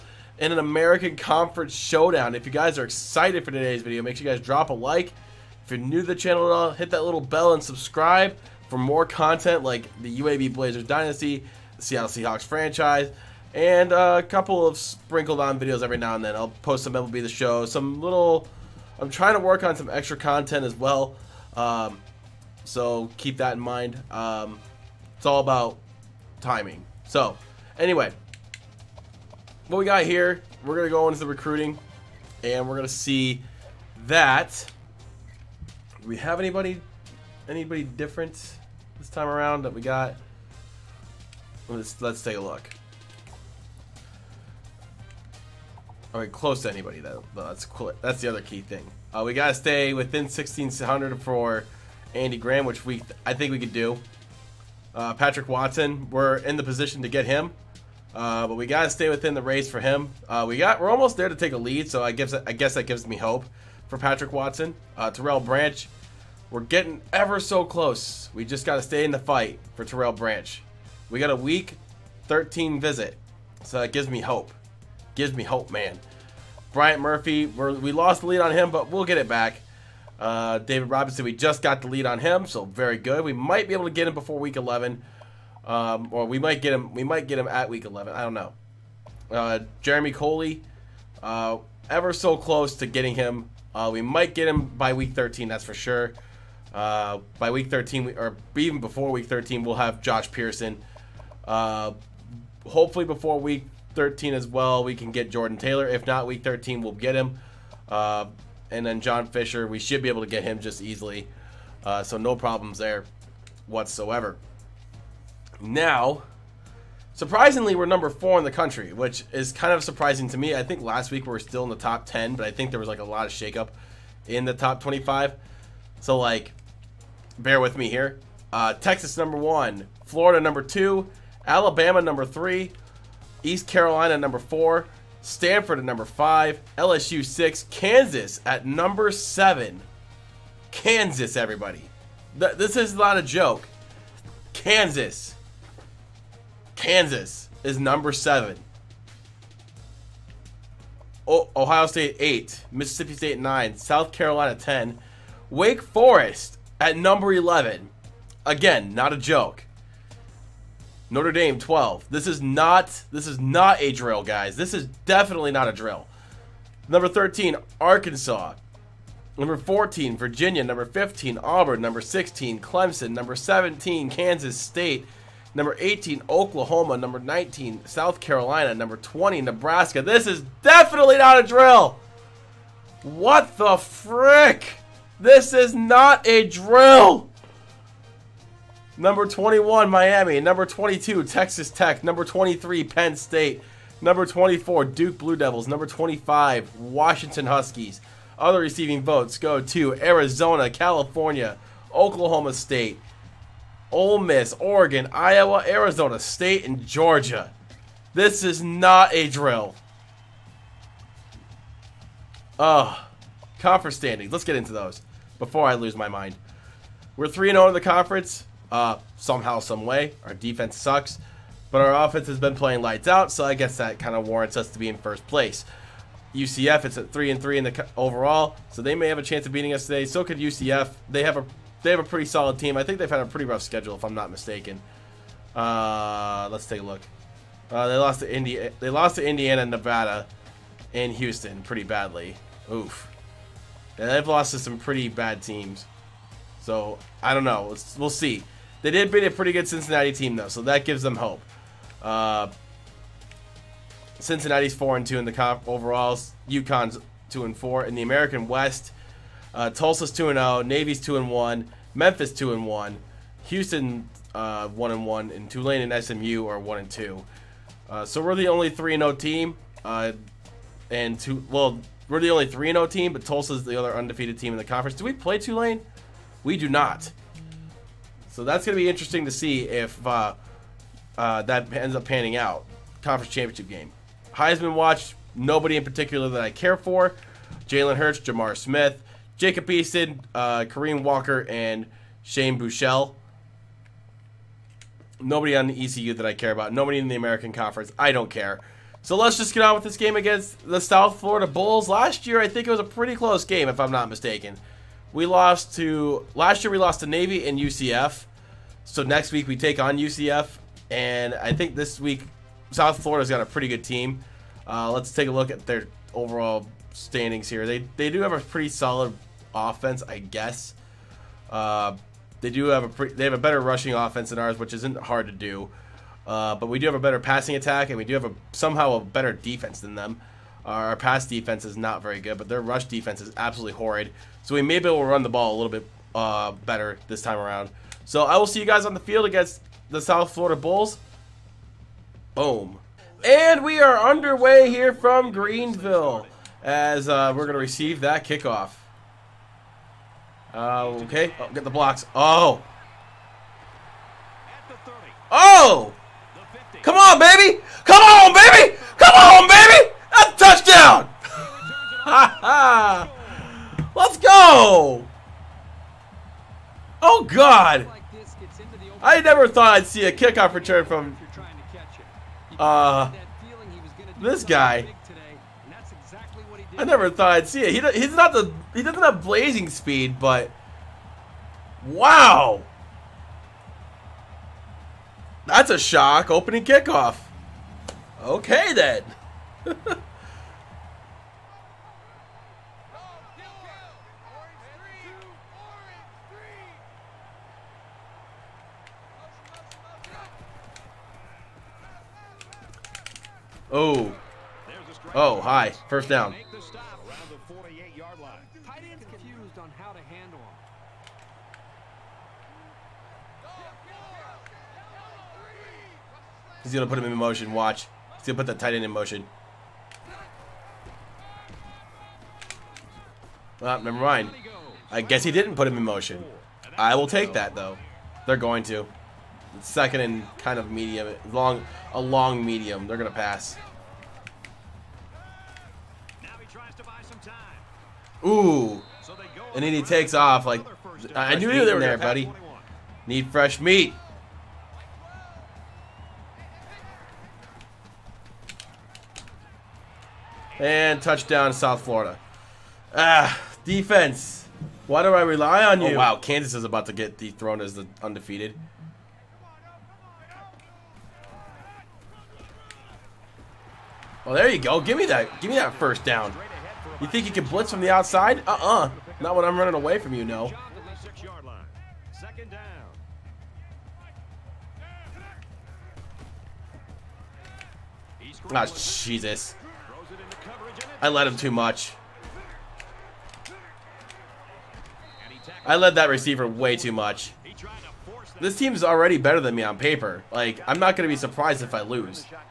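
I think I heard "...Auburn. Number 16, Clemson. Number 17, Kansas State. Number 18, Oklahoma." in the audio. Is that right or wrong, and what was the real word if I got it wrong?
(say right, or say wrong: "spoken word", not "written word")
right.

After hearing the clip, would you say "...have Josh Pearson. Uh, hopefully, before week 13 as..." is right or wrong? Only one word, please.
right.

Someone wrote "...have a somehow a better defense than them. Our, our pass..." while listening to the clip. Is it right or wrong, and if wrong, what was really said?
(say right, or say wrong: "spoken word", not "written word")
right.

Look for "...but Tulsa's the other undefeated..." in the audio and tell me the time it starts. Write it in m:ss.
4:33.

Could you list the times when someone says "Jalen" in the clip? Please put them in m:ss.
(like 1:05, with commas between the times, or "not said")
4:47.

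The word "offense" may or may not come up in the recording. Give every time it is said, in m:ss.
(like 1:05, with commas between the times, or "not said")
3:42, 5:19, 5:23.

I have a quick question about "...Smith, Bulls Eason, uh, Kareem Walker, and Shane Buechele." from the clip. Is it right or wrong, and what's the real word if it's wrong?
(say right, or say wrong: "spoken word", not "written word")
wrong: "Jacob", not "Bulls".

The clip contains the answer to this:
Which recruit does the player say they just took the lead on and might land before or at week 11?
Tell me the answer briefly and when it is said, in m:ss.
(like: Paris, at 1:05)
David Robinson, at 1:20.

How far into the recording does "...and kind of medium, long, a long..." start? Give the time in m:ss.
7:09.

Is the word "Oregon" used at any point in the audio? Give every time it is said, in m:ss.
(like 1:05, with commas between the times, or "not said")
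3:24.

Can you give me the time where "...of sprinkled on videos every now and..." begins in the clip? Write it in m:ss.
0:14.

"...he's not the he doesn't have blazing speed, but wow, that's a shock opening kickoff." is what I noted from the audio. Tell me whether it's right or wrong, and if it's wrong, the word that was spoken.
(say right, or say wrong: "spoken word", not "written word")
right.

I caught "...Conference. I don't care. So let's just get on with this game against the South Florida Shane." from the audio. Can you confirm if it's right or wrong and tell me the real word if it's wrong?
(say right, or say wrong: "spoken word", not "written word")
wrong: "Bulls", not "Shane".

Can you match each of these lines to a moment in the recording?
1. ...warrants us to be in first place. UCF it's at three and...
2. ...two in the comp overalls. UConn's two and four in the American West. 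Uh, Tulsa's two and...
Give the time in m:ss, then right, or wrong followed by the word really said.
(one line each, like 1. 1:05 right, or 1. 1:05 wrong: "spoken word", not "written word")
1. 3:44 right
2. 4:15 right.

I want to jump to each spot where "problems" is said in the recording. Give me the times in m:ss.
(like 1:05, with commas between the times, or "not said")
1:52.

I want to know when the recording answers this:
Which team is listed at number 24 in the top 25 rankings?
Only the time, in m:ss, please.
3:14.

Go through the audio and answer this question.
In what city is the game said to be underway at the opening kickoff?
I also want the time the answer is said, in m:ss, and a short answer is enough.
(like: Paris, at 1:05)
Greenville, at 5:45.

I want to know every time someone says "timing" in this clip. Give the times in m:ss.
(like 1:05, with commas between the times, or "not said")
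0:26.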